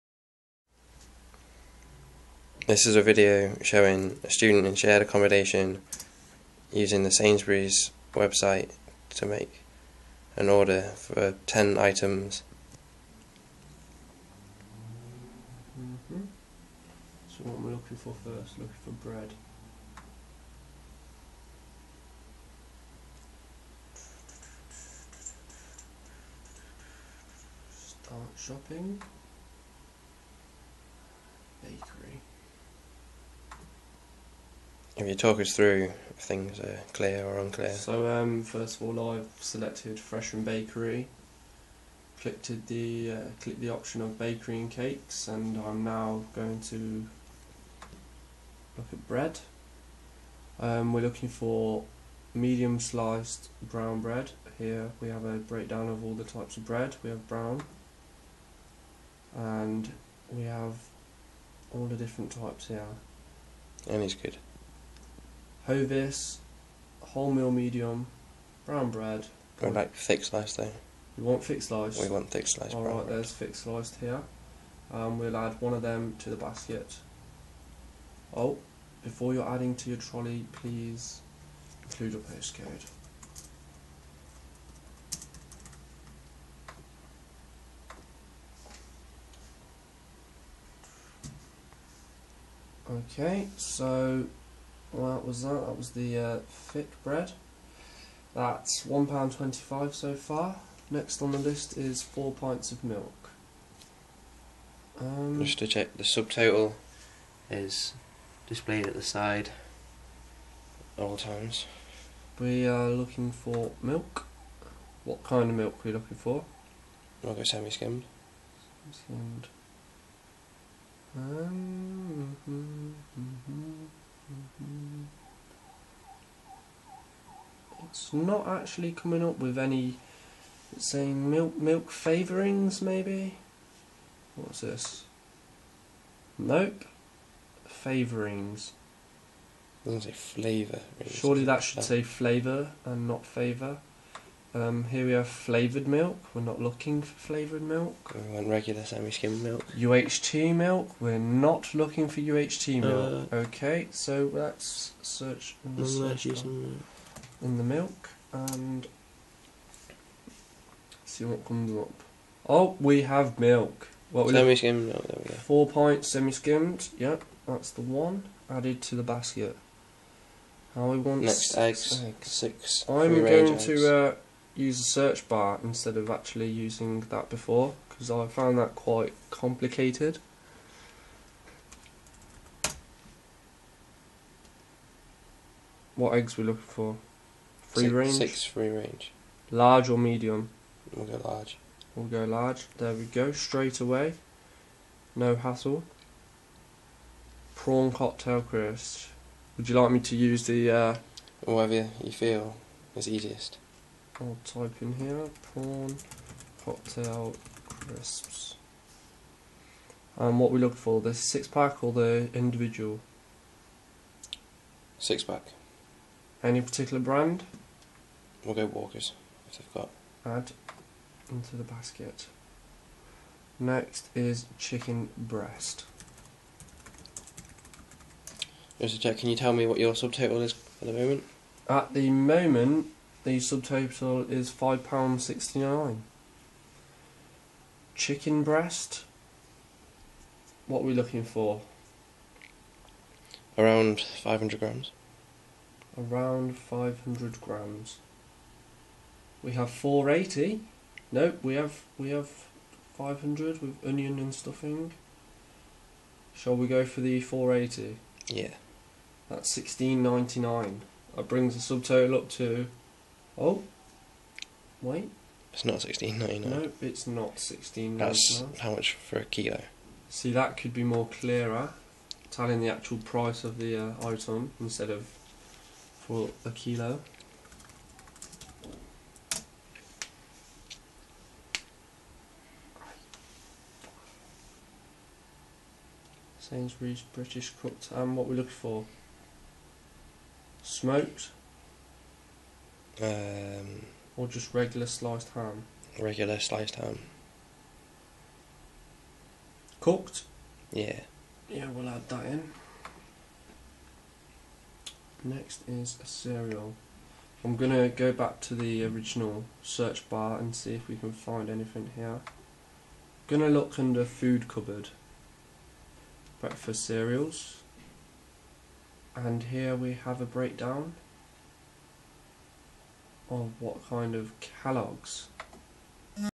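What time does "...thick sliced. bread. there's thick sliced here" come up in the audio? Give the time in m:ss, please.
1:12.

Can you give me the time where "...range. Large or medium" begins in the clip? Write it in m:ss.
3:08.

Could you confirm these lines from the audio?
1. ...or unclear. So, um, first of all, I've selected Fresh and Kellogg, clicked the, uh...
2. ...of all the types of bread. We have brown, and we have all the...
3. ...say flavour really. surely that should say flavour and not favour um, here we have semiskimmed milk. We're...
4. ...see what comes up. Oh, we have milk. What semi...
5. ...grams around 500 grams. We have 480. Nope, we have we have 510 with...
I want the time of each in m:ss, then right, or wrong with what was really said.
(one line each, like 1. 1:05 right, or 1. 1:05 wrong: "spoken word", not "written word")
1. 0:37 wrong: "Bakery", not "Kellogg"
2. 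0:55 right
3. 2:20 wrong: "flavoured", not "semiskimmed"
4. 2:41 right
5. 4:04 wrong: "500", not "510".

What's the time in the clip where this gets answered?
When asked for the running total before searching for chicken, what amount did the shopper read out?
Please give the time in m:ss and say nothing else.
3:54.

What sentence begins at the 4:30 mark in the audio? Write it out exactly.
See, that could be more clearer, telling the actual price of the uh, item instead of for a kilo.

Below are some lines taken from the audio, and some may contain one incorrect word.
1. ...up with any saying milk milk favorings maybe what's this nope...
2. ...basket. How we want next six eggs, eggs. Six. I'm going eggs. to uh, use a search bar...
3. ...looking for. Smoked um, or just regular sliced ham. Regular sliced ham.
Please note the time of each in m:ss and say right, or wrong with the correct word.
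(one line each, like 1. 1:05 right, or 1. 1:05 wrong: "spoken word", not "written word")
1. 2:09 right
2. 2:49 right
3. 4:48 right.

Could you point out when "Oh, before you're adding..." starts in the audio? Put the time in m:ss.
1:18.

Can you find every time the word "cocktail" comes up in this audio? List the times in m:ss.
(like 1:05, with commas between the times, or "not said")
3:17, 3:26.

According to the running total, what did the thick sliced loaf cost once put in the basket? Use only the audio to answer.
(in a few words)
£1.25.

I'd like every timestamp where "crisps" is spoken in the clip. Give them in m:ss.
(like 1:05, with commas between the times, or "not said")
3:18, 3:27.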